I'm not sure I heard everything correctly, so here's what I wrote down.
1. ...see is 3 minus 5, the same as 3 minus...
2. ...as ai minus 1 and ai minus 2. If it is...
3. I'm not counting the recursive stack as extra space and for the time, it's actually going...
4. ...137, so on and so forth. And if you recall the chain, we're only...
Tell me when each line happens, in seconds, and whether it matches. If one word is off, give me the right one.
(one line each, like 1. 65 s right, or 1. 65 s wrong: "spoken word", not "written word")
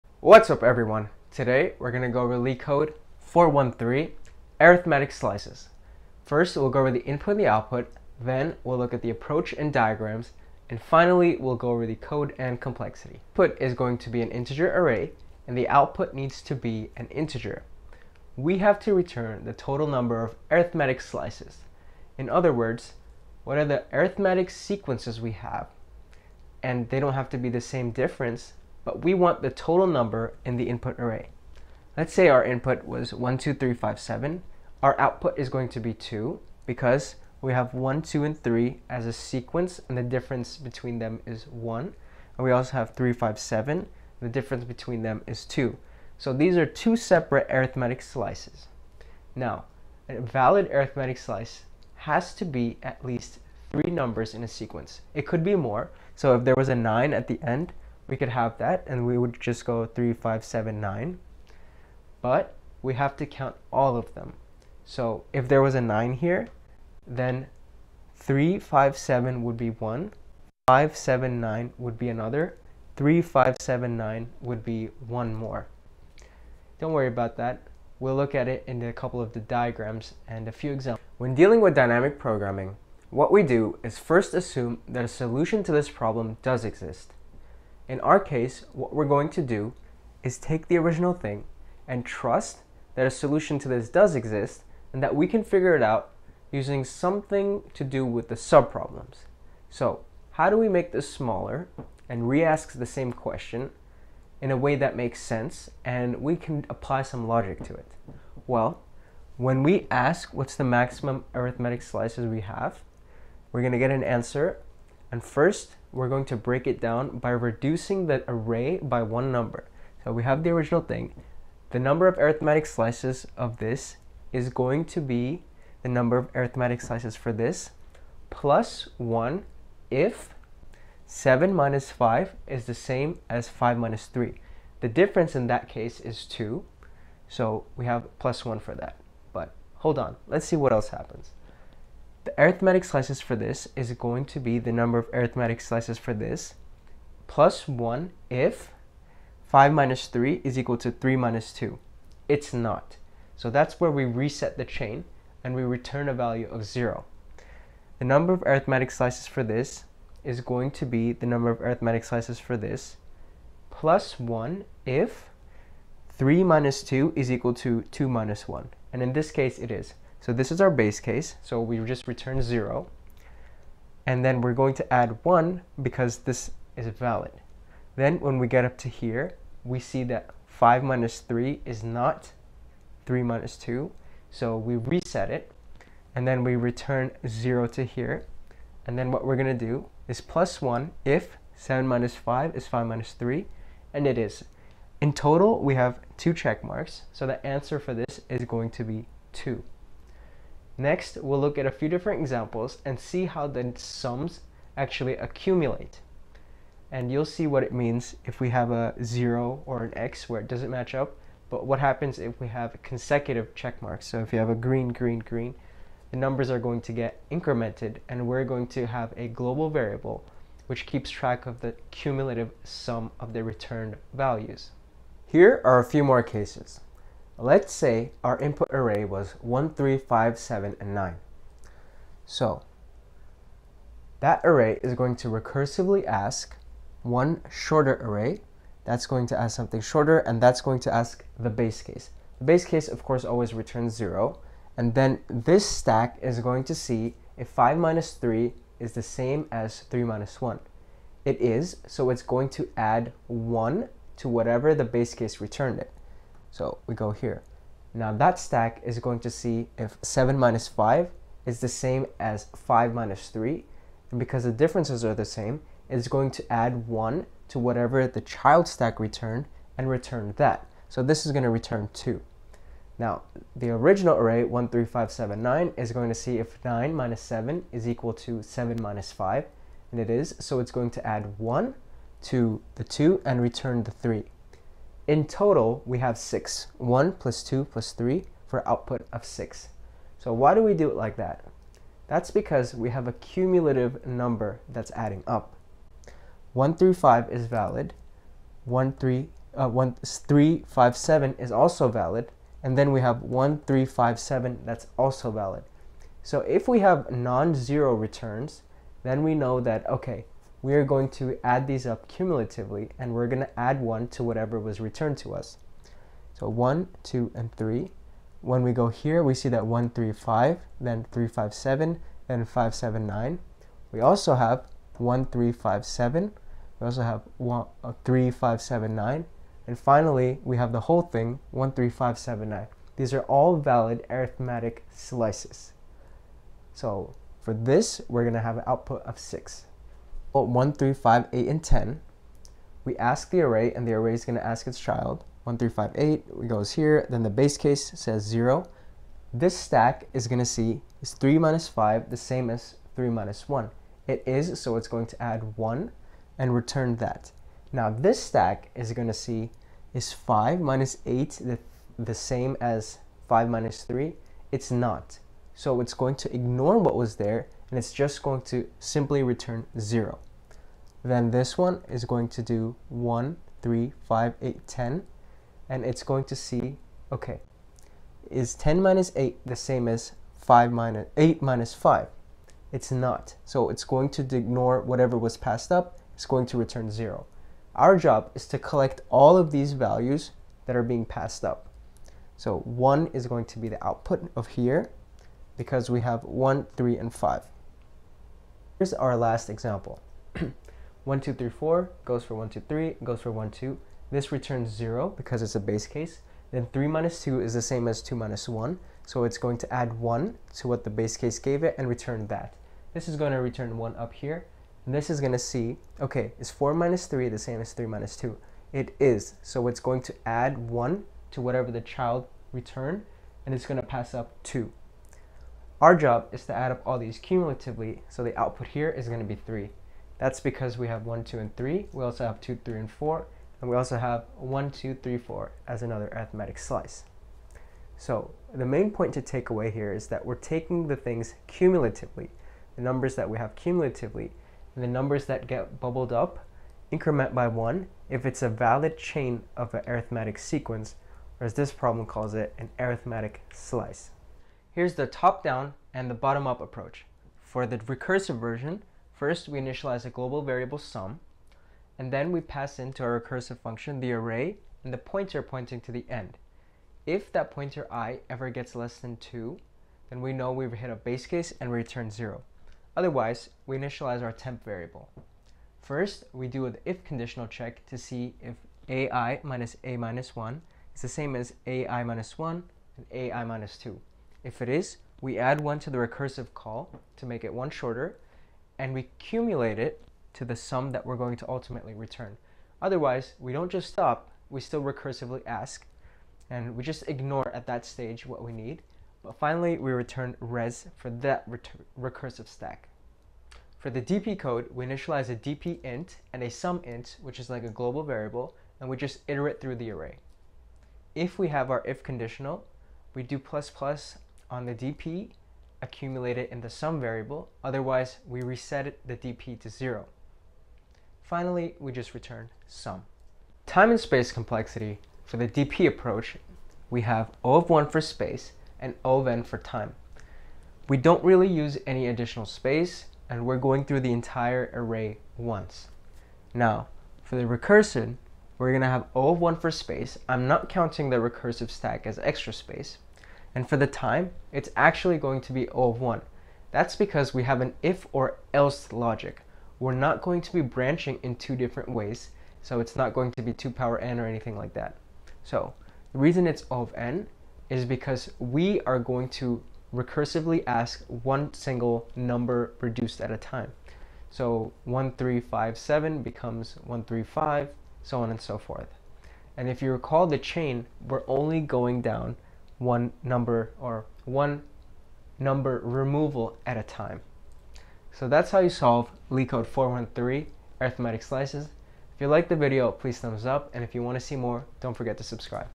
1. 350 s right
2. 481 s right
3. 540 s right
4. 566 s wrong: "135", not "137".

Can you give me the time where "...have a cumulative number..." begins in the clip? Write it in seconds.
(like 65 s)
292 s.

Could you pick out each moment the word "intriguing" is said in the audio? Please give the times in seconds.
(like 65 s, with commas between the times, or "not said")
not said.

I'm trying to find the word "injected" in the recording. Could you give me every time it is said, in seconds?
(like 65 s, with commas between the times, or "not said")
not said.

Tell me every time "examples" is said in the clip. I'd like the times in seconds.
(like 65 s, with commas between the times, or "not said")
80 s, 202 s, 399 s.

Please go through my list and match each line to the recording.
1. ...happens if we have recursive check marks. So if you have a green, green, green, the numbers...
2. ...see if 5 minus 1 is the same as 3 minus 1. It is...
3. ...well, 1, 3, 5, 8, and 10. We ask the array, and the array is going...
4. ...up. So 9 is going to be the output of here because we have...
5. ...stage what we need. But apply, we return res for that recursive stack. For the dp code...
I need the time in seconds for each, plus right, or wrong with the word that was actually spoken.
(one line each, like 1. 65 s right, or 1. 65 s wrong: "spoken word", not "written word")
1. 211 s wrong: "consecutive", not "recursive"
2. 246 s wrong: "3", not "1"
3. 340 s right
4. 391 s wrong: "1", not "9"
5. 497 s wrong: "finally", not "apply".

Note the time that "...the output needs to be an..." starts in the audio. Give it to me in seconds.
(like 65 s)
15 s.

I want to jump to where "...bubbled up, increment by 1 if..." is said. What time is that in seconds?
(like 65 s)
445 s.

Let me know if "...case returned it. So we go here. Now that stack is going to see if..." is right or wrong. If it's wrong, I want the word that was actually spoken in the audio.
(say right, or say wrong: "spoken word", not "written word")
right.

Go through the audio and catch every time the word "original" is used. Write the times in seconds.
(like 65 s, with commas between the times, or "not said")
90 s, 120 s, 273 s.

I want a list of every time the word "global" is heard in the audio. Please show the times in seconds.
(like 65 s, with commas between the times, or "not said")
219 s, 460 s, 507 s.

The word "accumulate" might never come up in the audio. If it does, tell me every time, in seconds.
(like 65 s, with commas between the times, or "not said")
205 s, 515 s.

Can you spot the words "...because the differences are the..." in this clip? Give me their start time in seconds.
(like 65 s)
264 s.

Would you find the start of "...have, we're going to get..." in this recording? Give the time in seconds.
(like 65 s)
112 s.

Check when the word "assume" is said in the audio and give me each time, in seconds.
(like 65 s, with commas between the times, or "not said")
84 s.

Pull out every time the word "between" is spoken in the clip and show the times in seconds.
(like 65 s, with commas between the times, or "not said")
40 s, 44 s.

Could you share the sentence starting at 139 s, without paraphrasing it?
But hold on, let's see what else happens.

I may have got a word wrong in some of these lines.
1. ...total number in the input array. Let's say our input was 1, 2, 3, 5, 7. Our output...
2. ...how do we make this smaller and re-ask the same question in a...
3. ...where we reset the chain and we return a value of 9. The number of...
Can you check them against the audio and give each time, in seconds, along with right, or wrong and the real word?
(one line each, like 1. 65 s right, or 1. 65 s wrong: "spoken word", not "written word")
1. 29 s right
2. 100 s right
3. 153 s wrong: "0", not "9".